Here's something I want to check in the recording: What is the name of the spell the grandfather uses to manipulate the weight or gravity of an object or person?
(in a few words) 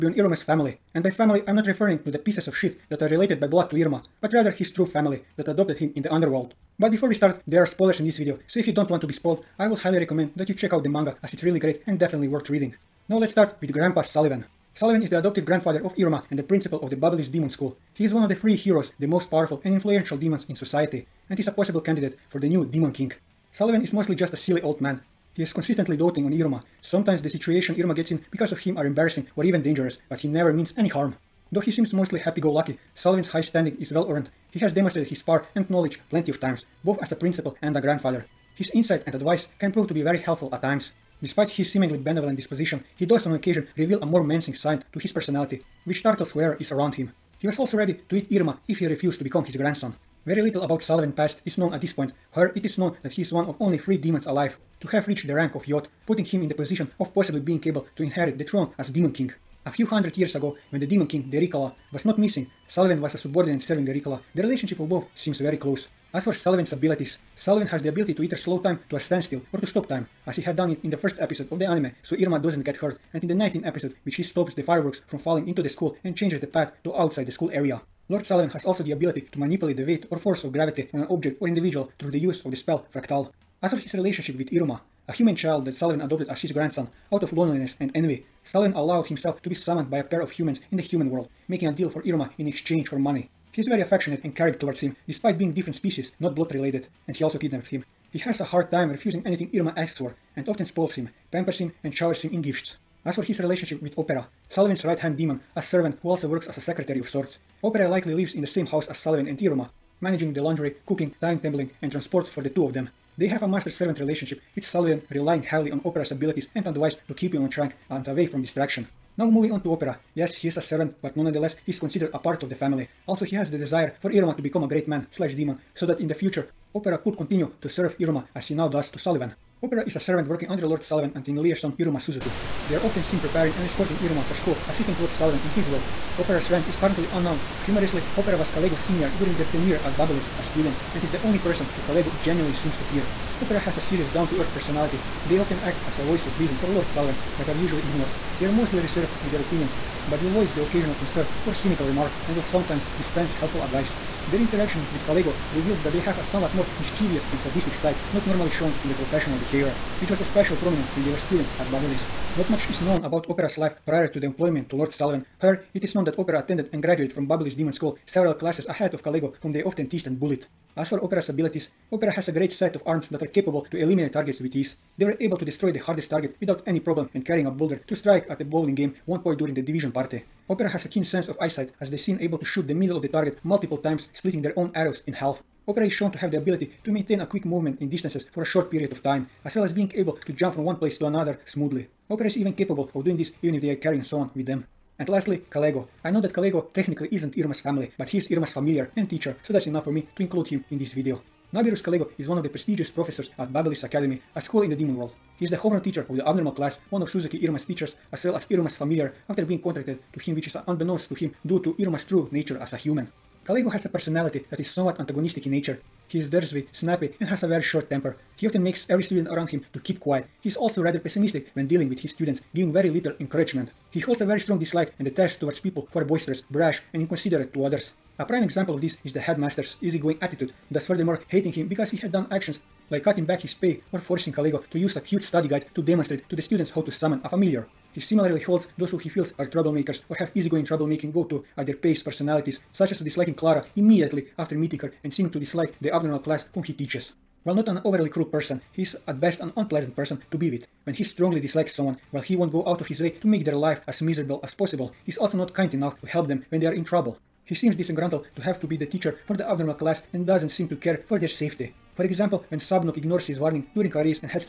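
Fractal.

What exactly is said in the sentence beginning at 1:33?
He is very affectionate and caring towards him despite being different species, not blood related, and he also kidnapped him.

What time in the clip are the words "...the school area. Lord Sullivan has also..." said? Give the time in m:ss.
1:17.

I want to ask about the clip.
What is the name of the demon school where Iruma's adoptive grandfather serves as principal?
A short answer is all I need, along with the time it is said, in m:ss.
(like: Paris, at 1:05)
Babylonish Demon School, at 0:16.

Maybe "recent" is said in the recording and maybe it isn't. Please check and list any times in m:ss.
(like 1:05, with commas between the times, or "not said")
not said.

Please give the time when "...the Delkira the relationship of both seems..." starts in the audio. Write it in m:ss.
1:03.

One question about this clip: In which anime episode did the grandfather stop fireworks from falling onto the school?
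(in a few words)
19.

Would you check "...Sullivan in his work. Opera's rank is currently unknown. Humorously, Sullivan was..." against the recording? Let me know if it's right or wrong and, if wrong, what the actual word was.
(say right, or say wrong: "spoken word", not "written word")
wrong: "Opera", not "Sullivan".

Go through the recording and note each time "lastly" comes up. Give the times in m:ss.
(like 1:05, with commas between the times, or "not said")
3:15.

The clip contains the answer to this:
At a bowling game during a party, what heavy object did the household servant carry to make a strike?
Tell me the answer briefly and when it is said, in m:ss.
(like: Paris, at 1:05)
A boulder, at 2:57.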